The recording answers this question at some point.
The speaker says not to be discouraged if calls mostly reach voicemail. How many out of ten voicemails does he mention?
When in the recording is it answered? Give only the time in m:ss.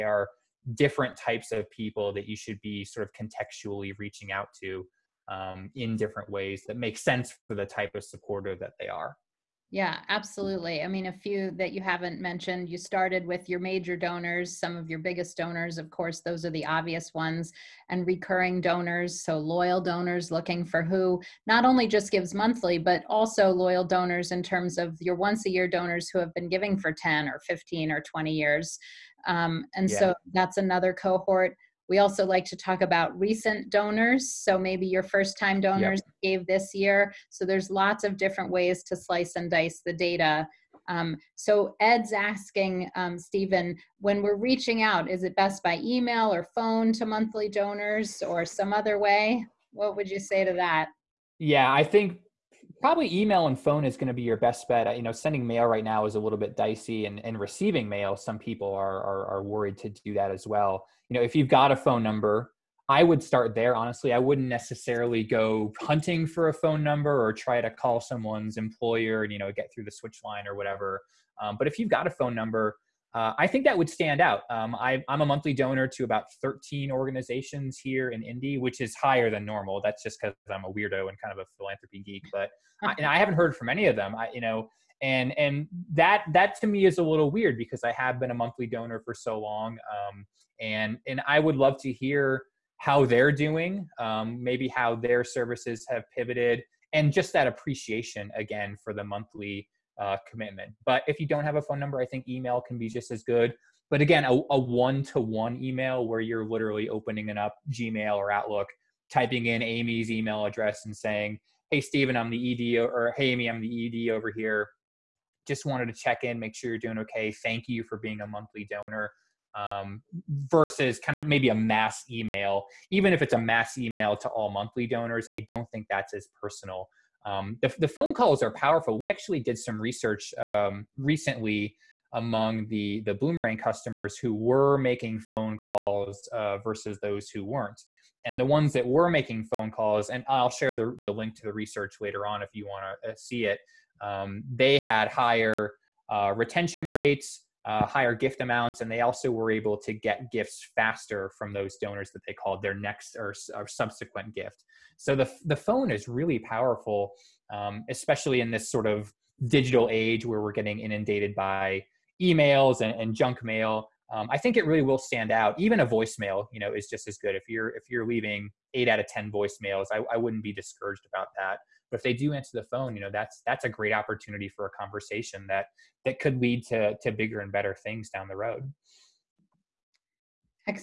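2:48.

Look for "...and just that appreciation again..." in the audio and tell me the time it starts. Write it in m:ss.
1:36.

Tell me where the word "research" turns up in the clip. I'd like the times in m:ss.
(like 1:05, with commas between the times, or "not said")
2:09, 2:21.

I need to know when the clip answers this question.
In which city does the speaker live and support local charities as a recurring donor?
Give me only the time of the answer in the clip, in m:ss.
1:18.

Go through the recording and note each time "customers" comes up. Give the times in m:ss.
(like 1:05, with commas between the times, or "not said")
2:13.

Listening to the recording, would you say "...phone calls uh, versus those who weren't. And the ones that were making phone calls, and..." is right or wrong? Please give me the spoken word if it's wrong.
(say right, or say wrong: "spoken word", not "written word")
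right.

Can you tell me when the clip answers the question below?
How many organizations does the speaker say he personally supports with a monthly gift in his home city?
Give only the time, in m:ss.
1:16.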